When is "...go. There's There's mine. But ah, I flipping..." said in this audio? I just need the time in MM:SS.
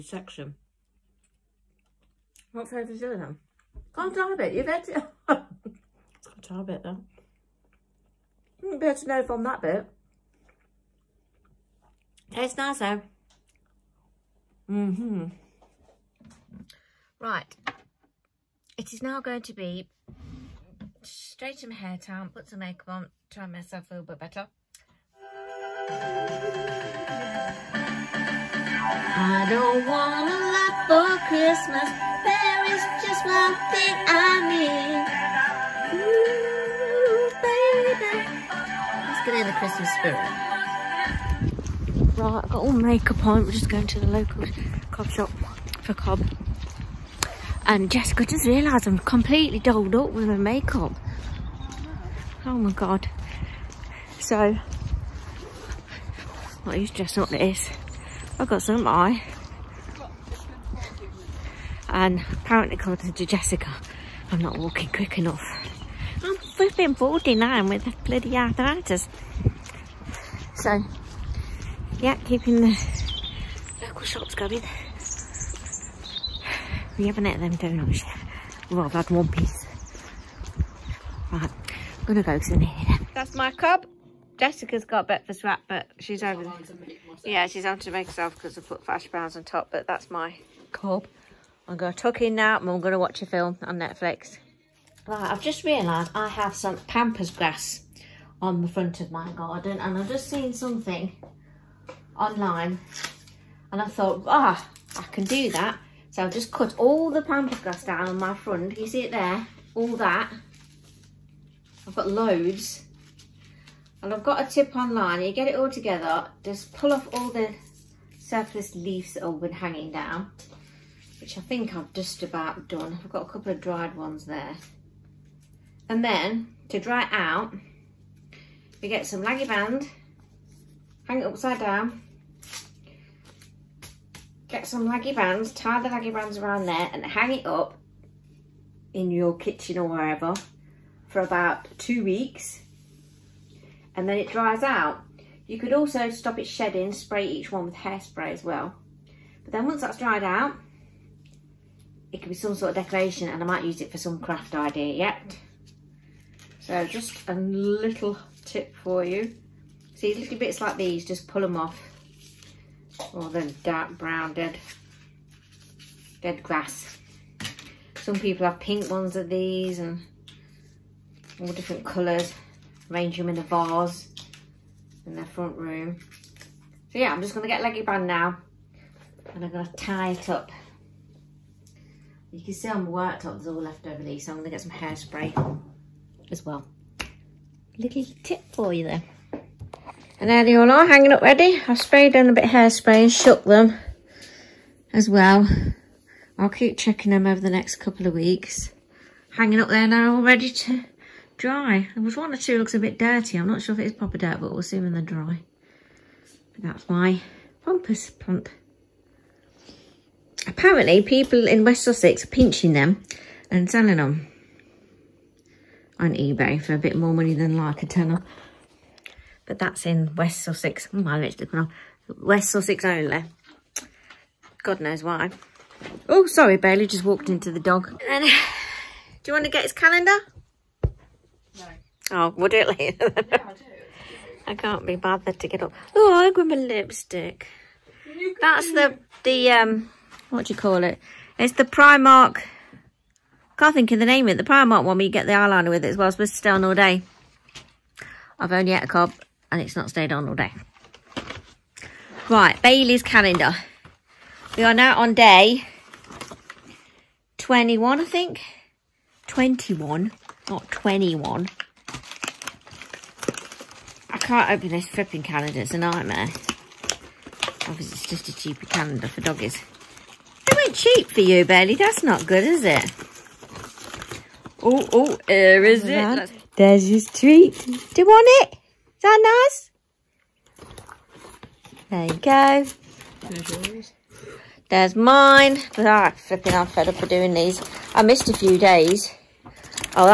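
04:42.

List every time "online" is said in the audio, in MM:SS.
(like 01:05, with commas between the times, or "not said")
01:42, 01:54.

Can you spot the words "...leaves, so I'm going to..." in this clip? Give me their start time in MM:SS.
03:04.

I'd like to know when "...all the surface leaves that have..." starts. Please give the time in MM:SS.
01:57.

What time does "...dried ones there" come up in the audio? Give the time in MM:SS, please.
02:03.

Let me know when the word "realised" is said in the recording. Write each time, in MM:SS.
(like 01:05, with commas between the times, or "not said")
00:48, 01:35.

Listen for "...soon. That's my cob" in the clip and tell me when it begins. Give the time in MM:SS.
01:22.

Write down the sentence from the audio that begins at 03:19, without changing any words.
Hanging up there now, all ready to dry.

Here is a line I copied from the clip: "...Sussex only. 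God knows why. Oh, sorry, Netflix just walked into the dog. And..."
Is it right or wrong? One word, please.
wrong.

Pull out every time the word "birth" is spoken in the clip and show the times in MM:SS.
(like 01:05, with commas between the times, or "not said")
not said.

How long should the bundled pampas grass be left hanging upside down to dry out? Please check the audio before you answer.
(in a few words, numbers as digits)
2 weeks.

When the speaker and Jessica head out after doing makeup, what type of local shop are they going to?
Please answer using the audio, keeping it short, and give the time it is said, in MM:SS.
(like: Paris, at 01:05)
cob shop, at 00:44.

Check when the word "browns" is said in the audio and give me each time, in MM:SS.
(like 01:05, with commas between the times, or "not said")
01:29, 02:43.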